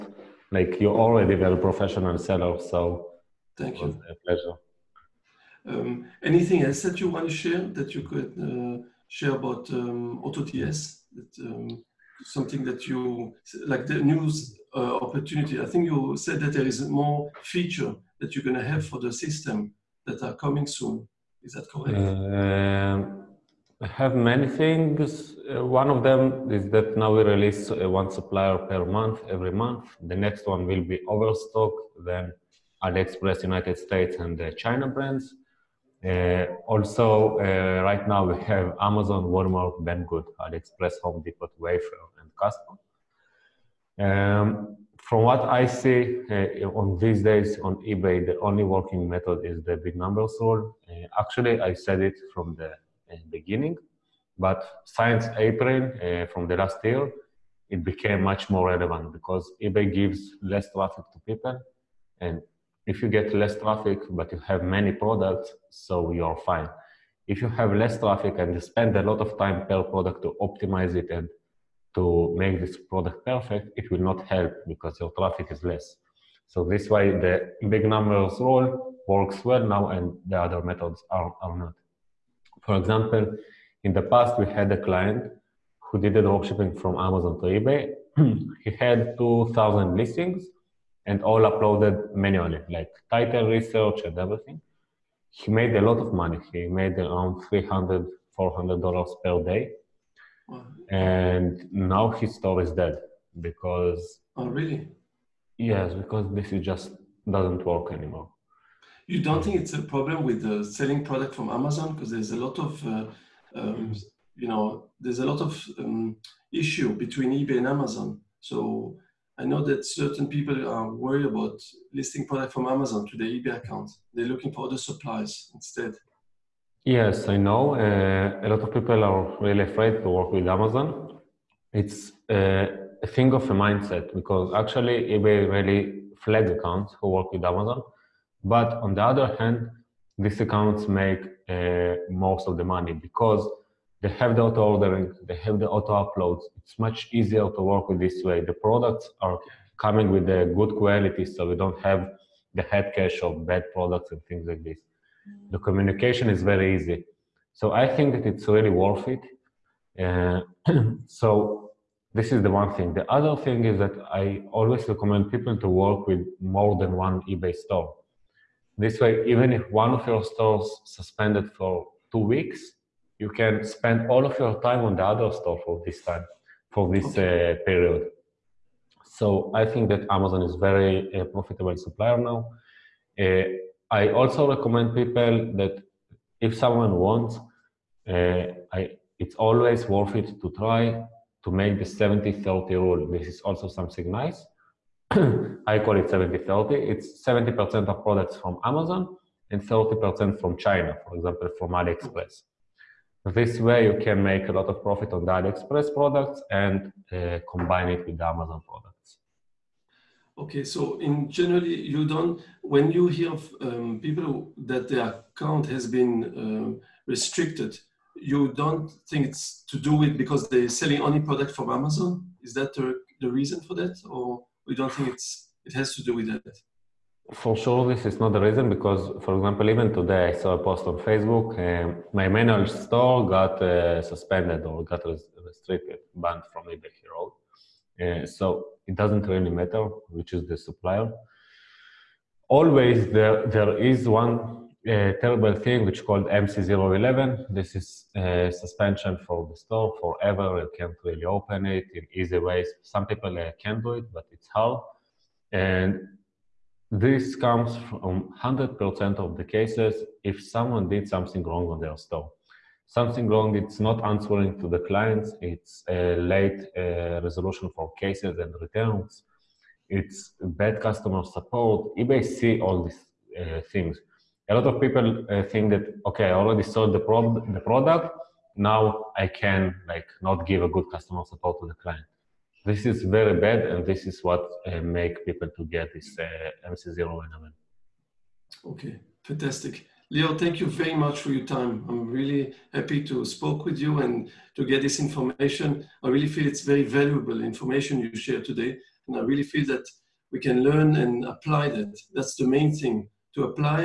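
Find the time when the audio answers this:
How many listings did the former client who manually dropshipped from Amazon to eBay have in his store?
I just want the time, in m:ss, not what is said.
1:29.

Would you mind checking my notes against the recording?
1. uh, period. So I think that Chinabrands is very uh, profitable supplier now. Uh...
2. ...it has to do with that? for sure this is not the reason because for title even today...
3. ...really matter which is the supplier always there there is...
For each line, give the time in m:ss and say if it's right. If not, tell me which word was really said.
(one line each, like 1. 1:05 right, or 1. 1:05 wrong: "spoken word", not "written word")
1. 2:57 wrong: "Amazon", not "Chinabrands"
2. 3:45 wrong: "example", not "title"
3. 3:59 right.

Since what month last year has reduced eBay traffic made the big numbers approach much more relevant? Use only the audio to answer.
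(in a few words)
April.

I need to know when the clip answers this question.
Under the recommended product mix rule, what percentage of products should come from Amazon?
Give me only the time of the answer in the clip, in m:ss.
3:17.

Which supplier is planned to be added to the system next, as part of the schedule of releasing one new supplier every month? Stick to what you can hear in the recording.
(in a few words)
Overstock.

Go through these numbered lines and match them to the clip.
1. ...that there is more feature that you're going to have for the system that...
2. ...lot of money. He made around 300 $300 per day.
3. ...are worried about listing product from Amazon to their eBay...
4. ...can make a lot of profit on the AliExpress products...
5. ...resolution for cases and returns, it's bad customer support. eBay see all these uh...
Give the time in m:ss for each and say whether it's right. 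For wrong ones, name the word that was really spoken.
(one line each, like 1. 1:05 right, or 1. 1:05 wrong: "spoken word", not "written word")
1. 0:16 right
2. 1:35 wrong: "400", not "300"
3. 2:00 right
4. 3:24 right
5. 4:27 right.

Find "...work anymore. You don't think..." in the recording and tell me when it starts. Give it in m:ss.
1:47.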